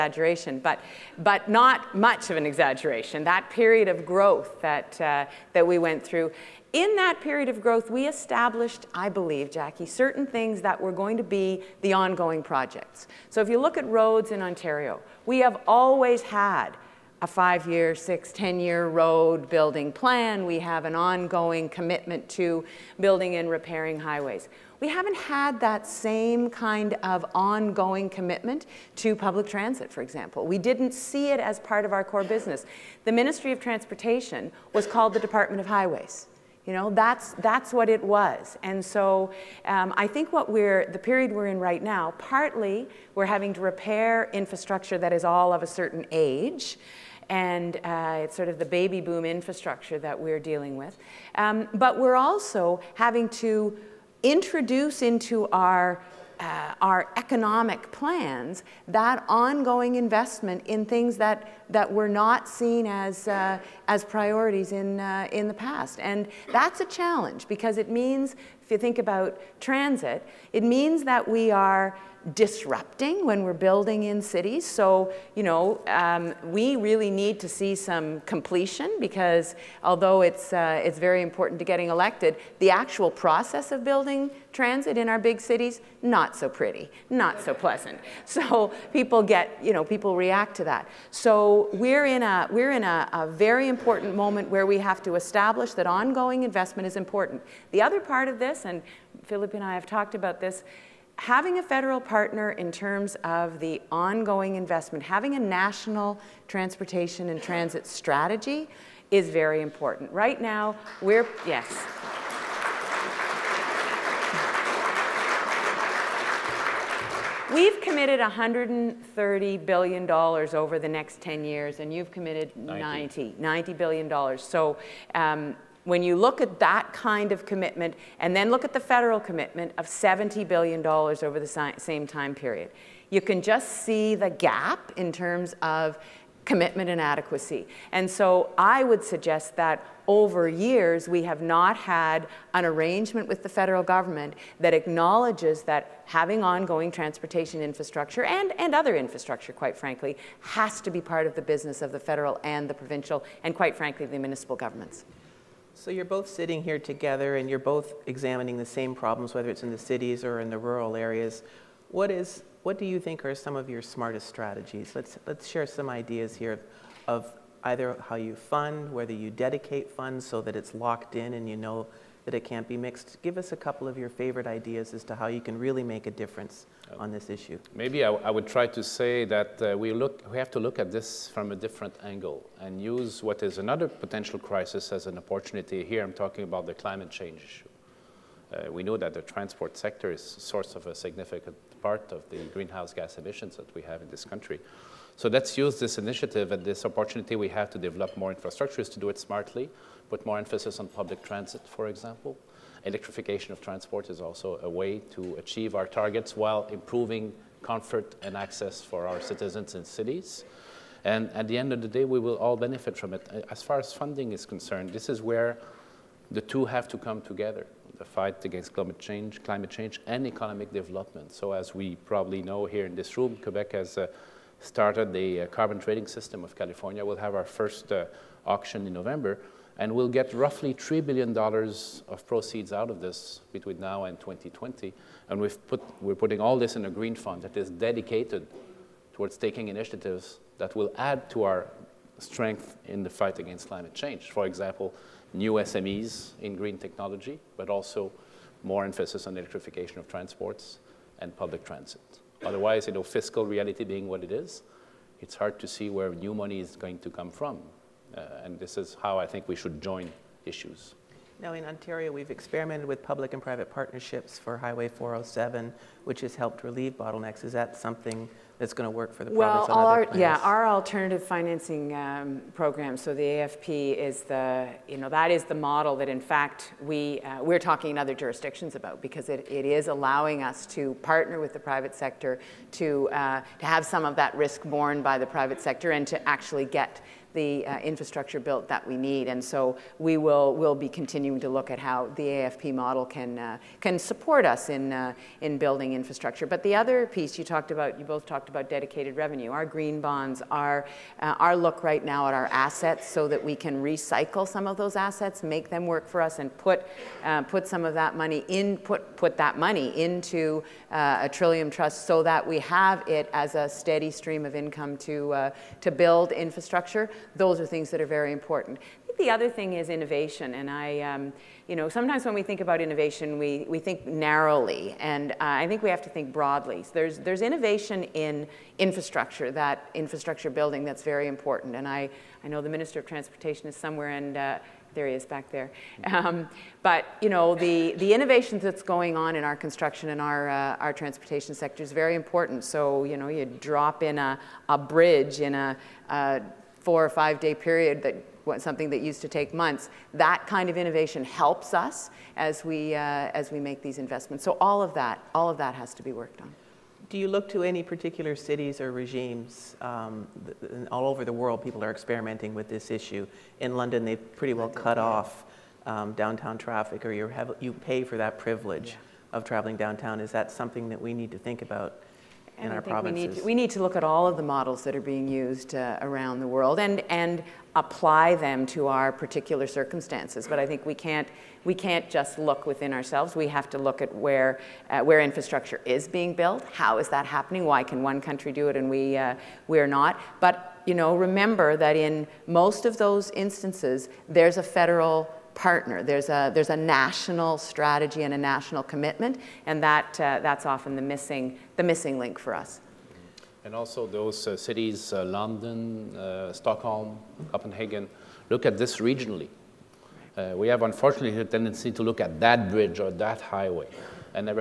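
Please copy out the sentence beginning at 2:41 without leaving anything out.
What, is, what do you think are some of your smartest strategies?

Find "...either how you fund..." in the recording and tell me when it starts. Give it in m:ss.
2:47.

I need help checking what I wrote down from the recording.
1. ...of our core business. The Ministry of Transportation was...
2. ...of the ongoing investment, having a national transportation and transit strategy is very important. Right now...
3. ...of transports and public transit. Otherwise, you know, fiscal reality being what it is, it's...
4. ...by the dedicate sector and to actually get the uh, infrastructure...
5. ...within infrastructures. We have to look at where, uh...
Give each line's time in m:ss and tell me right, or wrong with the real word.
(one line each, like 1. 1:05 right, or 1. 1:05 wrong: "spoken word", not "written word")
1. 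0:31 right
2. 1:43 right
3. 4:09 right
4. 4:45 wrong: "private", not "dedicate"
5. 6:22 wrong: "ourselves", not "infrastructures".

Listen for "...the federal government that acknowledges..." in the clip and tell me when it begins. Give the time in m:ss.
2:23.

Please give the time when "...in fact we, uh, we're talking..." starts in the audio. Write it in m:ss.
4:36.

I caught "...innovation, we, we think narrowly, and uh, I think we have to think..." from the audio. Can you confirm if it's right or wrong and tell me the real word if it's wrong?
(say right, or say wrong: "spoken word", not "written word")
right.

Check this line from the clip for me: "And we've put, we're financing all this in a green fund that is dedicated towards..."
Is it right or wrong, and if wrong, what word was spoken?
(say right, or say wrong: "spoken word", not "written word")
wrong: "putting", not "financing".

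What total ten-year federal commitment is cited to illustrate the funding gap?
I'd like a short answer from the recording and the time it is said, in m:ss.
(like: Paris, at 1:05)
$70 billion, at 2:09.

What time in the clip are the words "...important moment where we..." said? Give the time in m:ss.
1:33.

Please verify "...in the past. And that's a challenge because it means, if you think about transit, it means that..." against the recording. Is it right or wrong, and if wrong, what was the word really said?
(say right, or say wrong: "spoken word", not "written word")
right.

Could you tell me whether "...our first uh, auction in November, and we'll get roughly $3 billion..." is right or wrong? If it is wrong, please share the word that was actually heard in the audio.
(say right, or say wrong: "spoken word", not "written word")
right.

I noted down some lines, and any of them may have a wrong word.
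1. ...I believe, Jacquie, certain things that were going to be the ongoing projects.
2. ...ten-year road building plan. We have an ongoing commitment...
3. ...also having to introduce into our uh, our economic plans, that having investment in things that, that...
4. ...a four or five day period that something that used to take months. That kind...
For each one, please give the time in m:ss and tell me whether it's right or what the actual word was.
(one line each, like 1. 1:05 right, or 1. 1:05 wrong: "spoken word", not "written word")
1. 0:08 right
2. 0:18 right
3. 0:52 wrong: "ongoing", not "having"
4. 5:46 right.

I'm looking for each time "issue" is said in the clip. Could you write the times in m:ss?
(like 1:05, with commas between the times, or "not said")
2:57, 3:07, 4:20, 6:02.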